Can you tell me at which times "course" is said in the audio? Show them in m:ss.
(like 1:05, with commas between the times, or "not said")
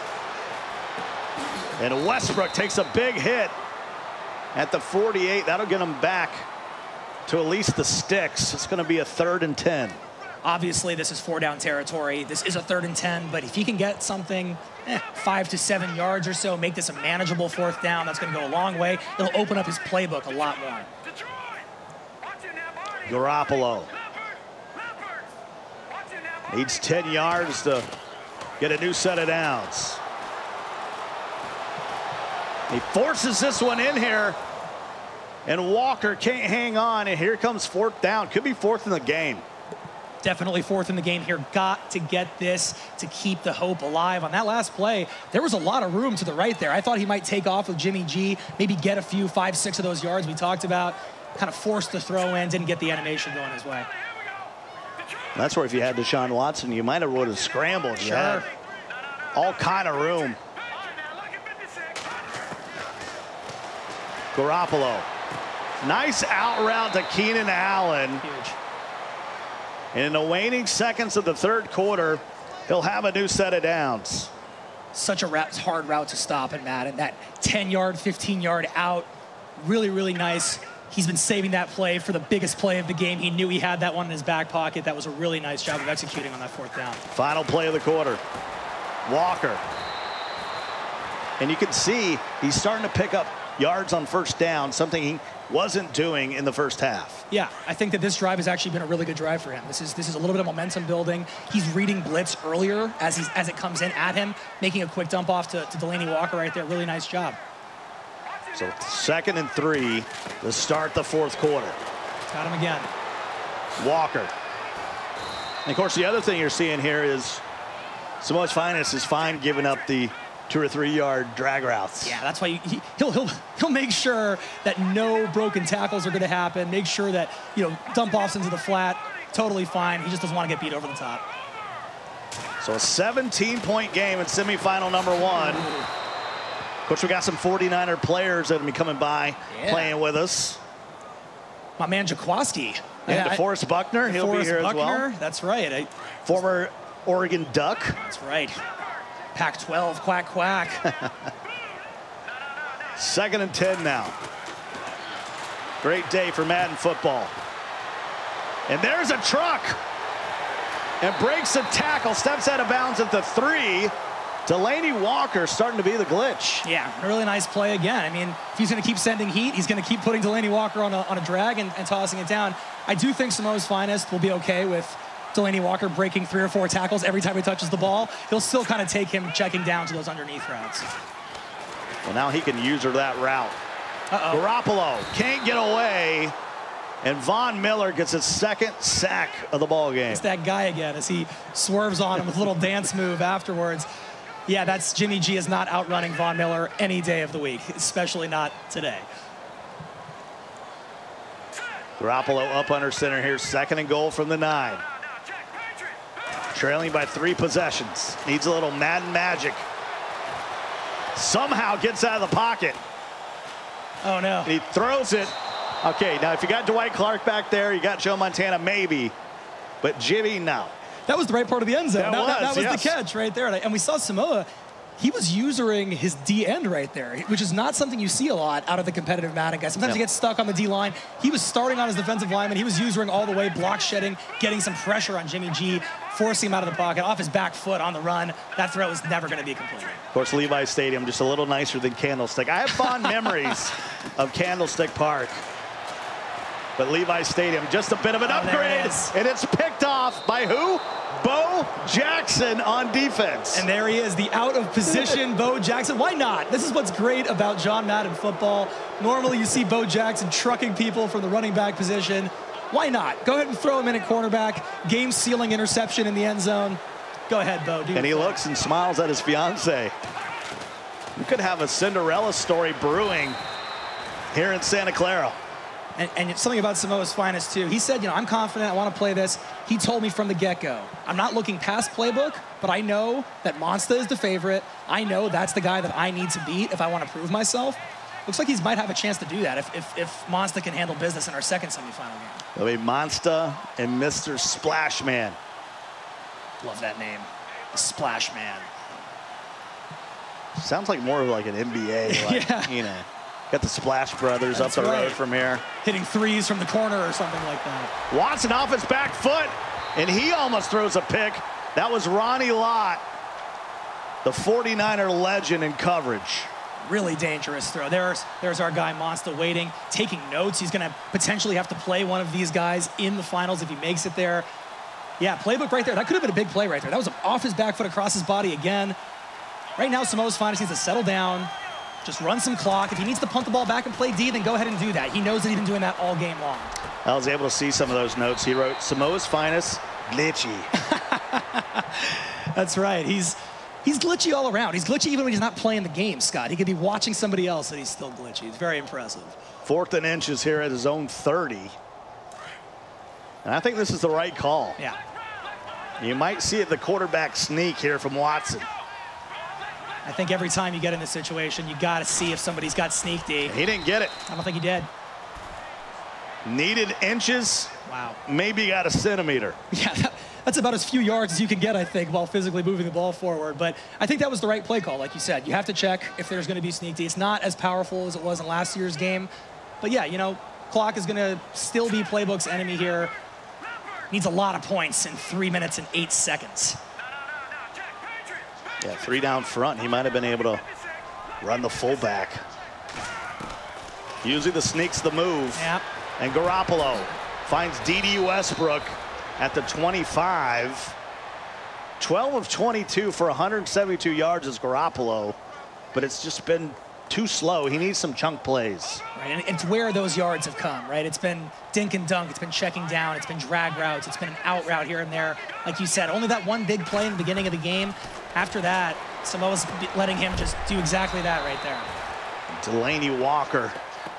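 1:55, 4:00.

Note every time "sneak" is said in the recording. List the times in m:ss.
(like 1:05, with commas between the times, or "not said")
5:57, 6:02, 6:16, 6:34.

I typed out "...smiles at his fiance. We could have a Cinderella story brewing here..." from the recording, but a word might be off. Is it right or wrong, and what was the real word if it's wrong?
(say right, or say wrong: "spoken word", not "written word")
right.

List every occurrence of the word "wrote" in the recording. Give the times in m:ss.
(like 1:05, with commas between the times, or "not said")
5:38.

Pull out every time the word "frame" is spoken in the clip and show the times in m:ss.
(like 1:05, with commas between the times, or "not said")
not said.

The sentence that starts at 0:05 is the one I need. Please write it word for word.
That'll get him back to at least the sticks.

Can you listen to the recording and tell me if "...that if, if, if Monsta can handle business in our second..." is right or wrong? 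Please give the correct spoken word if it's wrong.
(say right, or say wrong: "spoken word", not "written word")
right.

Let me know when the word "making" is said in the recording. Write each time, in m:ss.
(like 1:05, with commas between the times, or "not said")
1:44.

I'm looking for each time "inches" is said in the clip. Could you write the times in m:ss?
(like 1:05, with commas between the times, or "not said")
5:50, 6:07.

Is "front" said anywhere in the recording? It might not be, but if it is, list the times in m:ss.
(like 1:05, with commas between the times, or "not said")
6:29.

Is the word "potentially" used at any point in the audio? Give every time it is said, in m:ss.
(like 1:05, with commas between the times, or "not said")
5:21.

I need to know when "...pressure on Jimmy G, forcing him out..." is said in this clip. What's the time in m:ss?
3:54.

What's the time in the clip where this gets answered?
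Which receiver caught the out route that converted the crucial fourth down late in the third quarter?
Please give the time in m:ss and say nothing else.
1:07.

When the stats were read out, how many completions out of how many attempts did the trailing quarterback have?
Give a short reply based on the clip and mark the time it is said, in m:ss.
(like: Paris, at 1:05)
12 of 22, at 6:41.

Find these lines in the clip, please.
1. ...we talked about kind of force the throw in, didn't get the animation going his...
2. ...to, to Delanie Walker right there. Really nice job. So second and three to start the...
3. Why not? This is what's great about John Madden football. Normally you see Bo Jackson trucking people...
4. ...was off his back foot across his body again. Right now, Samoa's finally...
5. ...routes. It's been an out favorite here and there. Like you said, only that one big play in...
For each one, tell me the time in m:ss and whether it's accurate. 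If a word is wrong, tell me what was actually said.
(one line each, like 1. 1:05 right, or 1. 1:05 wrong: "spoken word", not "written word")
1. 0:50 right
2. 1:45 right
3. 4:15 right
4. 5:26 right
5. 6:53 wrong: "route", not "favorite".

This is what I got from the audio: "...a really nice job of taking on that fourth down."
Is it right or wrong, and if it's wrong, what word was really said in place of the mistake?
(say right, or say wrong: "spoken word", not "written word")
wrong: "executing", not "taking".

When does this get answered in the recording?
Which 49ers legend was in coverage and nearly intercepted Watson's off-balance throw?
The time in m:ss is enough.
5:12.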